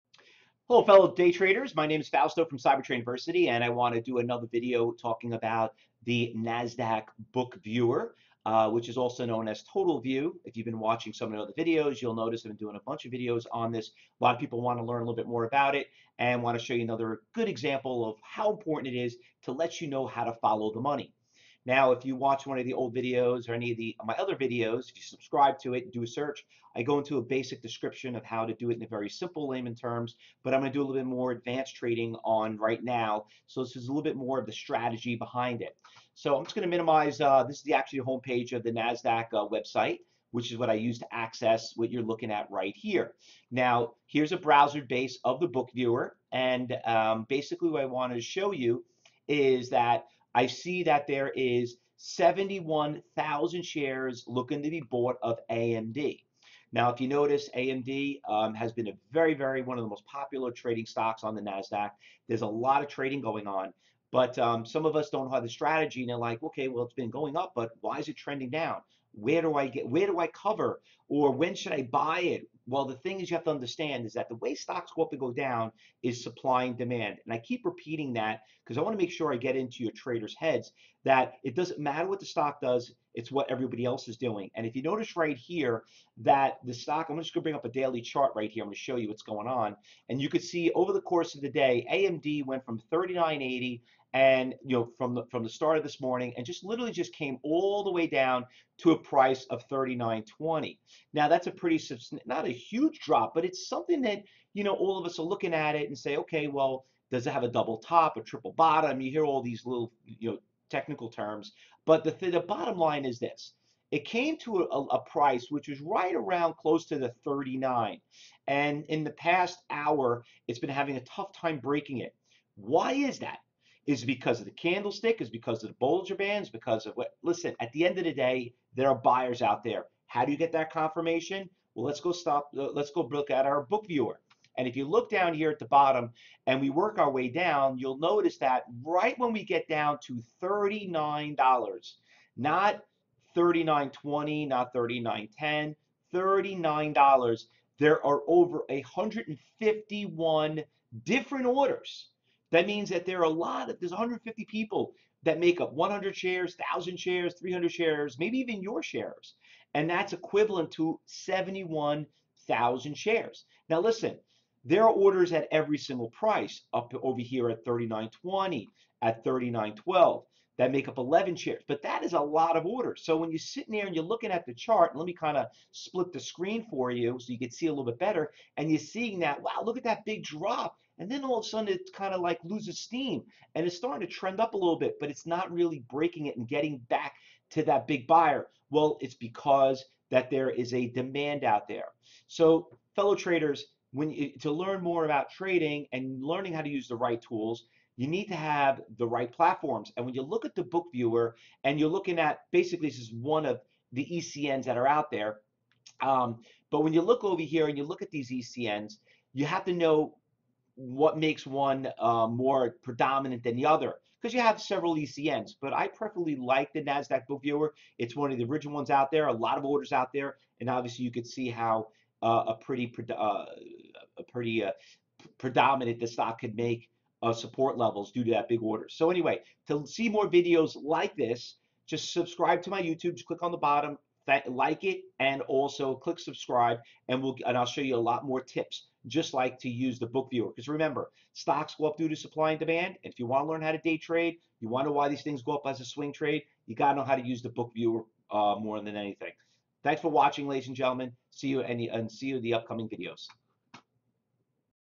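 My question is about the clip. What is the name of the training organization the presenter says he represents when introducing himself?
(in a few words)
Cyber Trading University.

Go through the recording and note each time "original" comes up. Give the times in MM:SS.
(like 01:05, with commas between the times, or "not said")
03:38.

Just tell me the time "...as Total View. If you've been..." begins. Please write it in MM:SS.
00:09.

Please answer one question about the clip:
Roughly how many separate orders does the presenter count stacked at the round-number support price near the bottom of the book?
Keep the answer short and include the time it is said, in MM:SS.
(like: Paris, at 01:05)
151, at 02:28.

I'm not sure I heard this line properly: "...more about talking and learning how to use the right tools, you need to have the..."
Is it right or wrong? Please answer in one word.
wrong.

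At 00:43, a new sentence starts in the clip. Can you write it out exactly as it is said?
Now, here's a browser base of the book viewer.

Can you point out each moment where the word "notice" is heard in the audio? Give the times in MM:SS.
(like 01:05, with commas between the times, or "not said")
00:12, 00:57, 01:24, 02:17.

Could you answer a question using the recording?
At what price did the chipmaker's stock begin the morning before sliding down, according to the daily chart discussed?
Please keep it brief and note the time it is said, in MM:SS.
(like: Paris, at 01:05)
39.80, at 01:32.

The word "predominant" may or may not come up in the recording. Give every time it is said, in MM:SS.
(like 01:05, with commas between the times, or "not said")
03:32, 03:45.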